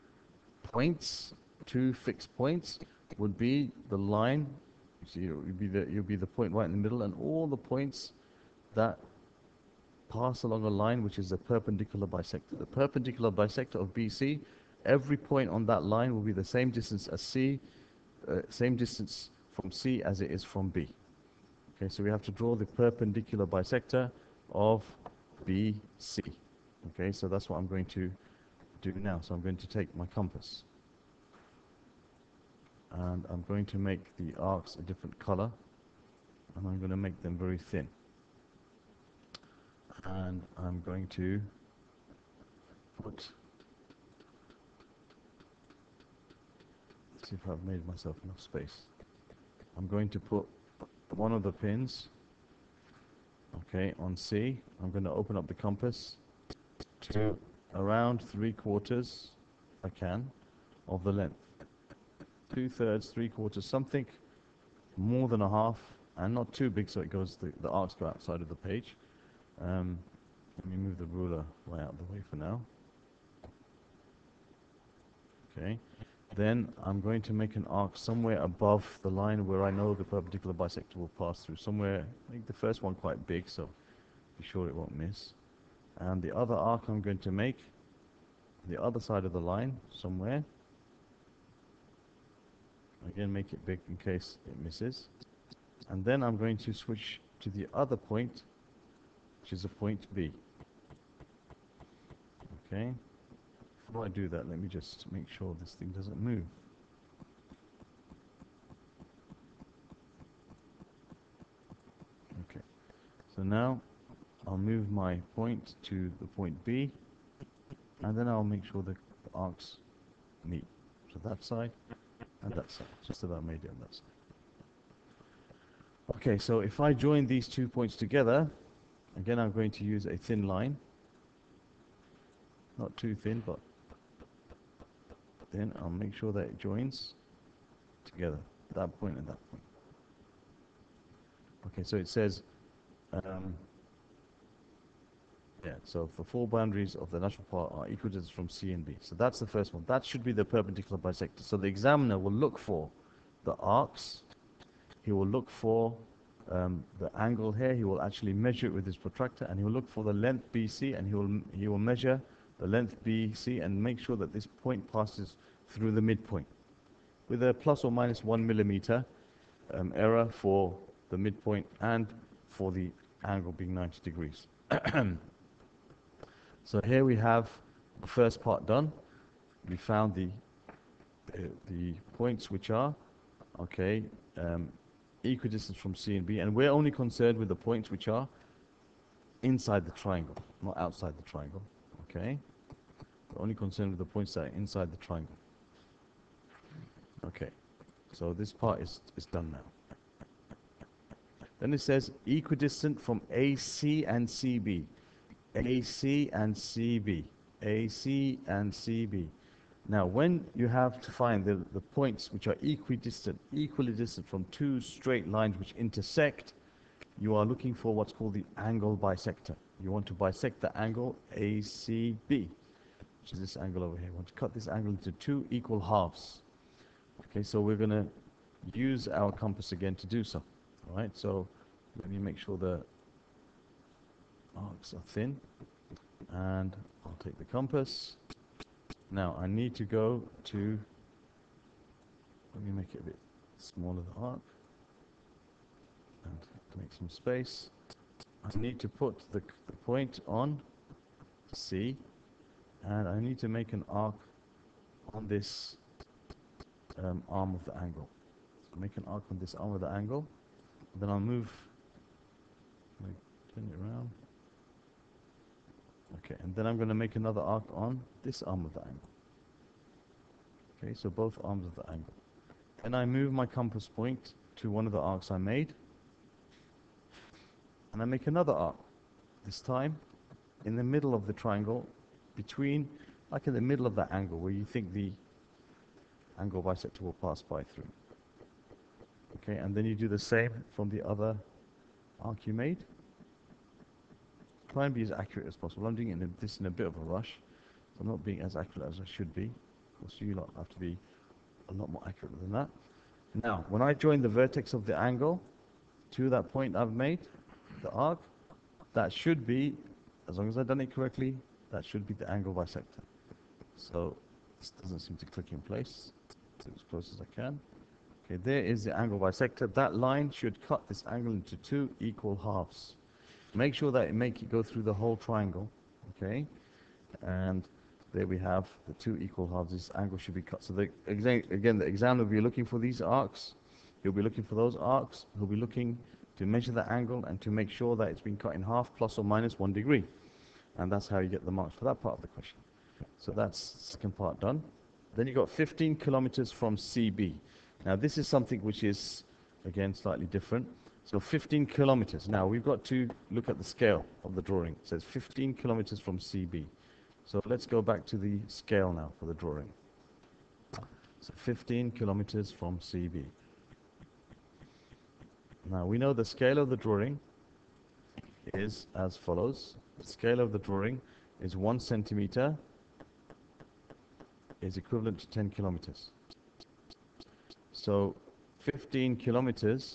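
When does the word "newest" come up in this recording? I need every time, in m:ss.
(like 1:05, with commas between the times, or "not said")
not said.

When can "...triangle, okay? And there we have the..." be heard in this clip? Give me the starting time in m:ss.
5:25.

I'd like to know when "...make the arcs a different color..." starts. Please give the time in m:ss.
0:33.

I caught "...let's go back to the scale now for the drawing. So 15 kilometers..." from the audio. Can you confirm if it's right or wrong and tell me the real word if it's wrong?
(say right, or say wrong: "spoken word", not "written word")
right.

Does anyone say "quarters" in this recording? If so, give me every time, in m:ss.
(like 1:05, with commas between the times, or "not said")
0:58, 1:03.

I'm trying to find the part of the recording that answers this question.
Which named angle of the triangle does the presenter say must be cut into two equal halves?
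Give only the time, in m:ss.
3:41.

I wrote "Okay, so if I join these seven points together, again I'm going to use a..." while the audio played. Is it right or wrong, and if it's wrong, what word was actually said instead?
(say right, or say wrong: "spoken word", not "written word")
wrong: "two", not "seven".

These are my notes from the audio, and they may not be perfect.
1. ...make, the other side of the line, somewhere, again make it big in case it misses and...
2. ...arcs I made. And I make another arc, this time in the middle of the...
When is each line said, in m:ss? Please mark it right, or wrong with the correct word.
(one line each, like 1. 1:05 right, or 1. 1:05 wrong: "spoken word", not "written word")
1. 1:27 right
2. 4:34 right.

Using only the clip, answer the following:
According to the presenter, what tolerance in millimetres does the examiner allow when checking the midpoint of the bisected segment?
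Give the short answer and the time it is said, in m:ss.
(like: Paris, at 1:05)
1 millimeter, at 2:48.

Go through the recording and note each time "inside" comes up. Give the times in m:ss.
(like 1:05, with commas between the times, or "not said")
3:09, 3:14.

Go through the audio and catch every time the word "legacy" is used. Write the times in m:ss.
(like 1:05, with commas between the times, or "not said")
not said.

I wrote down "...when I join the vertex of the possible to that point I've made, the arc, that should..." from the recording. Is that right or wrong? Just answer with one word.
wrong.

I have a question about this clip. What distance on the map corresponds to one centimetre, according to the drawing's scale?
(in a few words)
10 kilometers.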